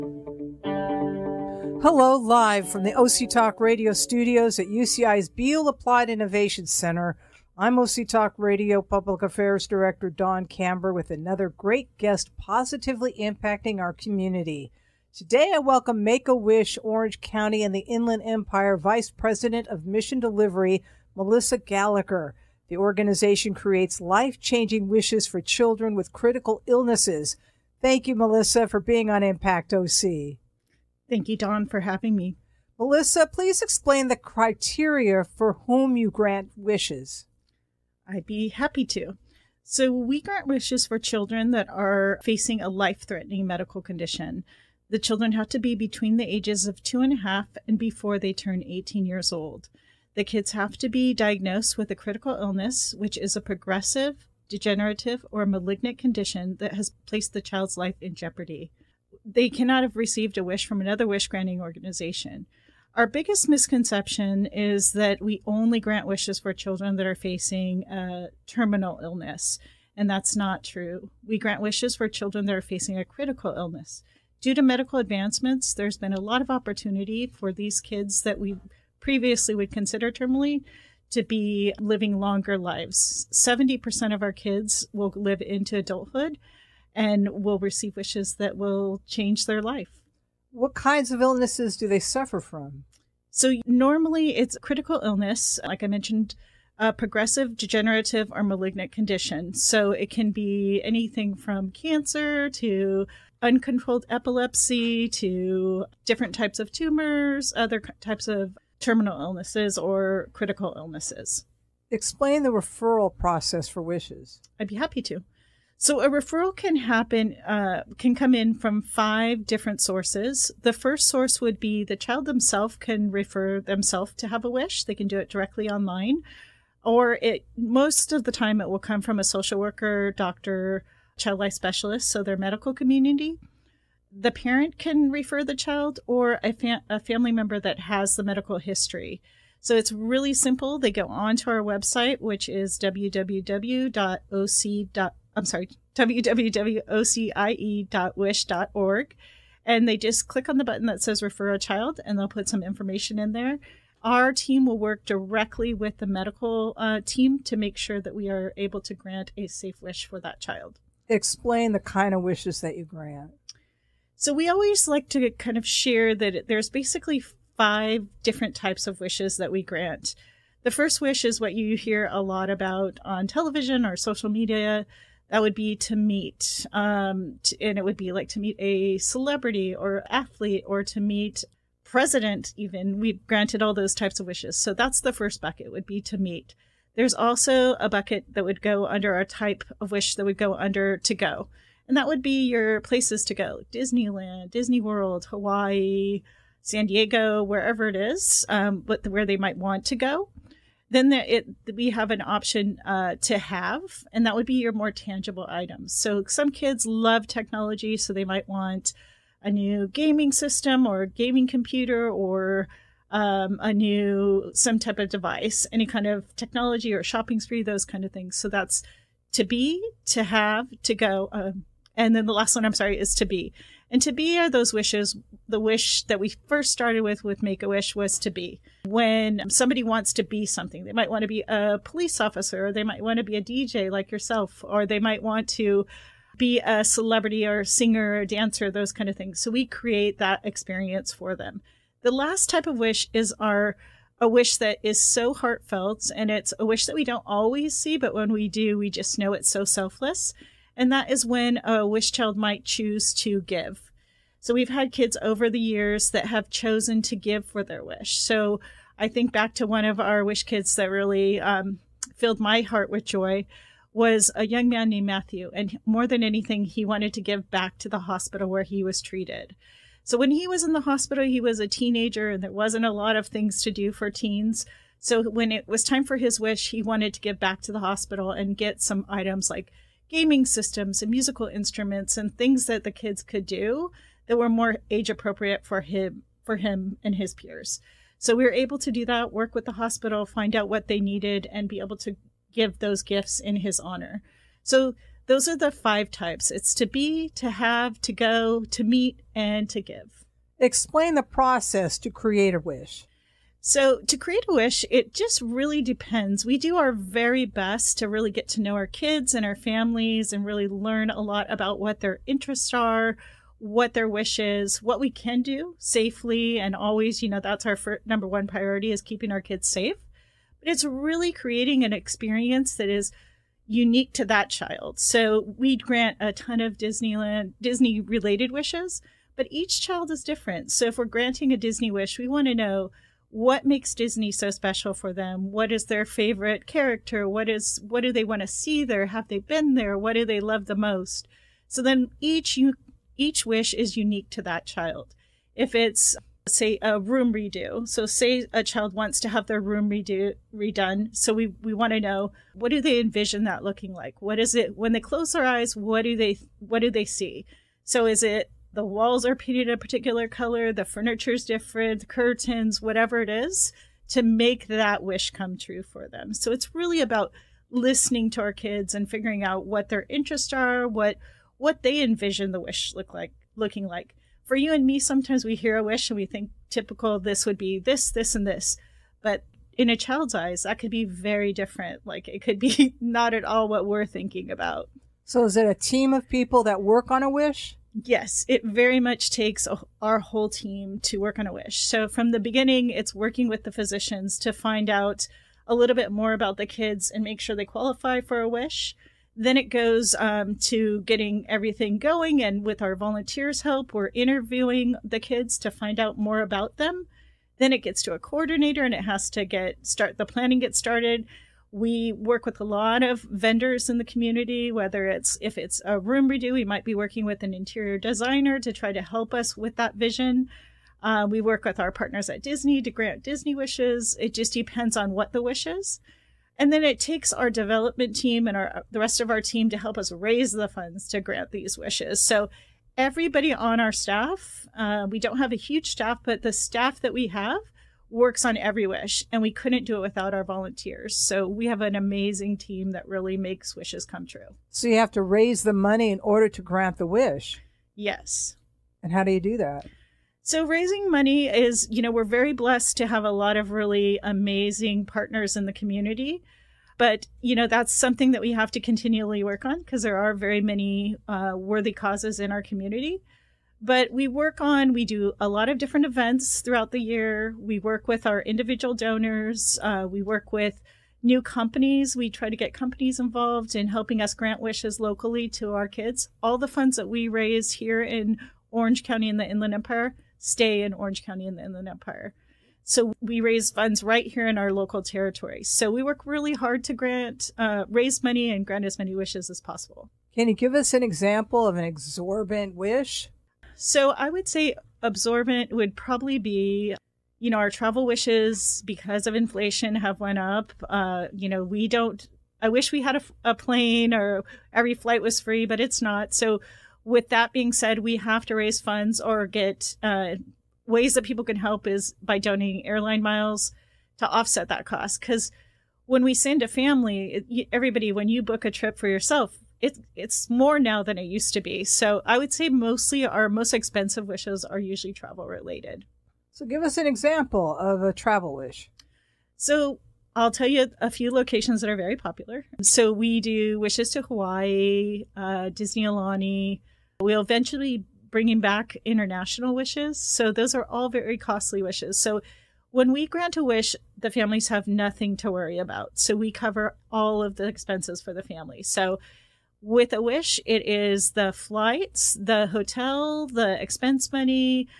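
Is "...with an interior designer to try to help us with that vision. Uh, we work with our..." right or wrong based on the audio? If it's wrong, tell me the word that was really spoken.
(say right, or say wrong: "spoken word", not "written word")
right.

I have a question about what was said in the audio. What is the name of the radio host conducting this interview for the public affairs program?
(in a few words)
Dawn Kamber.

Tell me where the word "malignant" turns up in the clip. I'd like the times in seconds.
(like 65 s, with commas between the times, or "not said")
55 s, 98 s.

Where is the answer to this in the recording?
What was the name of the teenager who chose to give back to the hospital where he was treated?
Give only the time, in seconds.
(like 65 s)
265 s.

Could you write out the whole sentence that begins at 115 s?
So a referral can happen, uh, can come in from five different sources.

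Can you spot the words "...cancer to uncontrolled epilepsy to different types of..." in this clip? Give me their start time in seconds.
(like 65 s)
101 s.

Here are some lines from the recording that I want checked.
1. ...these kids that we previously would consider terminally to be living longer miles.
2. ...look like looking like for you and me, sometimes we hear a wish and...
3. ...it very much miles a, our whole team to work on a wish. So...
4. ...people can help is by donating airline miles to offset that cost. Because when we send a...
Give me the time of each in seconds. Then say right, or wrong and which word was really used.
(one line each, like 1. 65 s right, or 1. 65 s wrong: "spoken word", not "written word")
1. 77 s wrong: "lives", not "miles"
2. 372 s right
3. 388 s wrong: "takes", not "miles"
4. 511 s right.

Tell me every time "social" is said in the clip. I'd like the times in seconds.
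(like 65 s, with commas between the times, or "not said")
129 s, 173 s.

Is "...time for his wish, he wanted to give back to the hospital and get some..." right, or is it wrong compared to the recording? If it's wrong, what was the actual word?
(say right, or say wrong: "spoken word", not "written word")
right.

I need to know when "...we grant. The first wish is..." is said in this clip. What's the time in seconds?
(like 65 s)
169 s.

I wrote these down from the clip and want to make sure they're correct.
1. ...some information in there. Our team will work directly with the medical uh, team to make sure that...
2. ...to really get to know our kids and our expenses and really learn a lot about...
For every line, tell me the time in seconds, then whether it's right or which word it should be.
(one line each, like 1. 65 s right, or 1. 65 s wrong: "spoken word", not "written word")
1. 152 s right
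2. 307 s wrong: "families", not "expenses".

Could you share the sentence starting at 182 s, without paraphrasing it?
Even we granted all those types of wishes.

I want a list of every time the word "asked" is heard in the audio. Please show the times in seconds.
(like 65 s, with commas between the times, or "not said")
not said.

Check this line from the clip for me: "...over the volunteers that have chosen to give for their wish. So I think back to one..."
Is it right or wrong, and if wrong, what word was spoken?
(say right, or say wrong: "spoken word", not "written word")
wrong: "years", not "volunteers".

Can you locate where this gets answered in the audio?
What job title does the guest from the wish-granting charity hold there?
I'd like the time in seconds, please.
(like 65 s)
18 s.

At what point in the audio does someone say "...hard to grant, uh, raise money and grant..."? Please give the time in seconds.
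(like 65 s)
486 s.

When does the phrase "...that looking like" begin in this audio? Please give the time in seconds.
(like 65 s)
353 s.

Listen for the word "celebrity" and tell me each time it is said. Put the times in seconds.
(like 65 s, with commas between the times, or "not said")
178 s, 236 s.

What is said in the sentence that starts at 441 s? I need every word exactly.
So we have an amazing team that really makes wishes come true.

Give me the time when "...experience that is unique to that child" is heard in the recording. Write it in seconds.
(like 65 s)
321 s.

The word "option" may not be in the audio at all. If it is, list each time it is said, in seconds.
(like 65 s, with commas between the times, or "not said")
202 s.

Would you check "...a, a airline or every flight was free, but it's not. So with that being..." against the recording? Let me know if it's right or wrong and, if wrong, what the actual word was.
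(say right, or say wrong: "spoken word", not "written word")
wrong: "plane", not "airline".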